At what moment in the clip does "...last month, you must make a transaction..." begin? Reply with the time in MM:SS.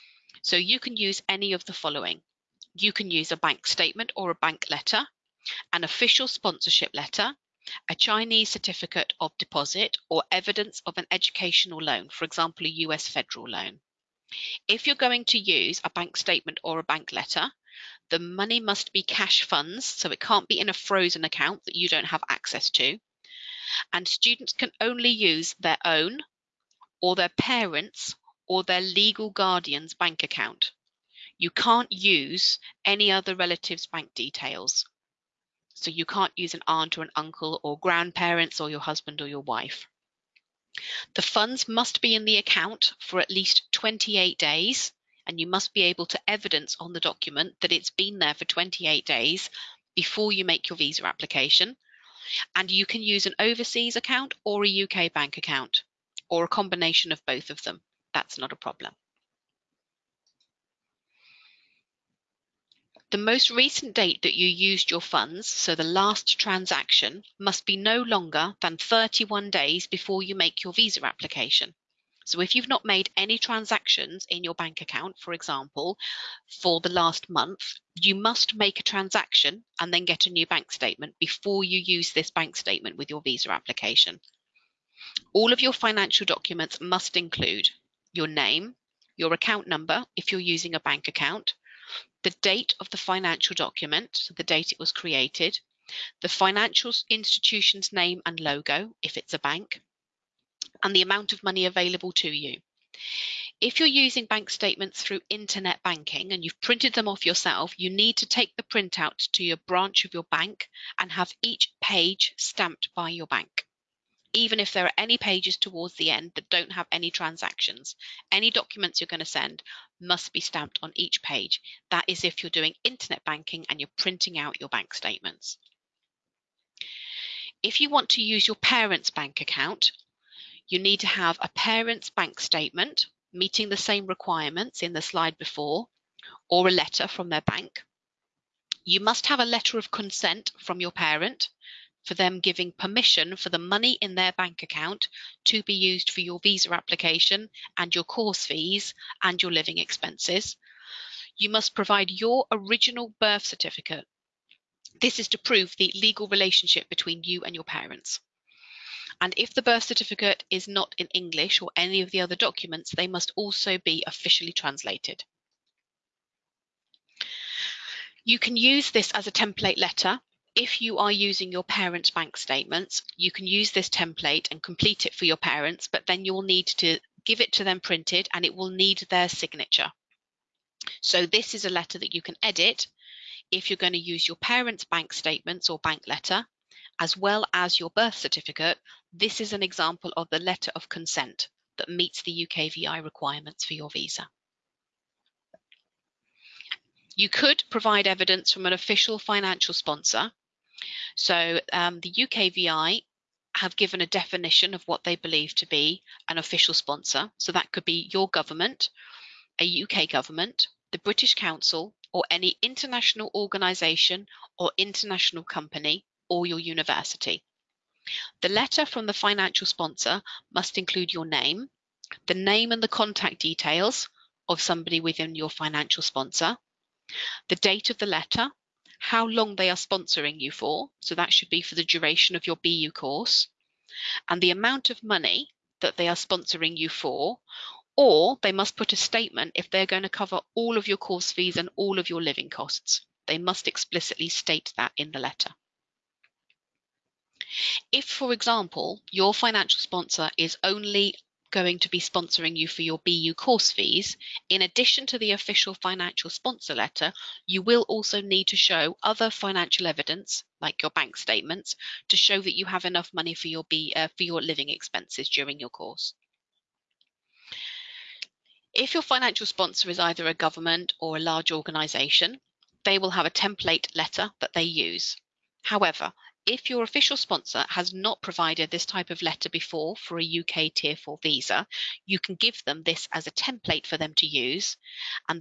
01:16.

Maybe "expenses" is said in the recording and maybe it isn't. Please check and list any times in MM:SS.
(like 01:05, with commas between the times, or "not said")
02:29, 04:24.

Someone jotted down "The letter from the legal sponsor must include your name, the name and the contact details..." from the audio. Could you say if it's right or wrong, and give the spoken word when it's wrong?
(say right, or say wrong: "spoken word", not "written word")
wrong: "financial", not "legal".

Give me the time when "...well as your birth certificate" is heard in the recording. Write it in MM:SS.
03:07.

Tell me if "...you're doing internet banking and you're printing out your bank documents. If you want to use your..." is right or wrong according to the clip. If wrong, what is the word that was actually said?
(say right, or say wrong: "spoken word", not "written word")
wrong: "statements", not "documents".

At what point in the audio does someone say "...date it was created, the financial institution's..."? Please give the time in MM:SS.
01:34.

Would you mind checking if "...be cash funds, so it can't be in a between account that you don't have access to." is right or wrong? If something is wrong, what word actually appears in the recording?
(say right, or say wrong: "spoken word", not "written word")
wrong: "frozen", not "between".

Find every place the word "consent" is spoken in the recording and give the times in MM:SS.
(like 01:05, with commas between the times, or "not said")
02:19, 03:10.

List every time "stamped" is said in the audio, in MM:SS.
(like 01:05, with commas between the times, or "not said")
01:52, 02:00.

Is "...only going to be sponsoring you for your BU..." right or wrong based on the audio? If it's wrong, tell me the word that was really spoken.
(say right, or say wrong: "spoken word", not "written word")
right.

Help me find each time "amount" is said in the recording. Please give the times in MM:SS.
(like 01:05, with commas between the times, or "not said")
01:41, 03:54.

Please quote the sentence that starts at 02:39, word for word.
And if the birth certificate is not in English or any of the other documents, they must also be officially translated.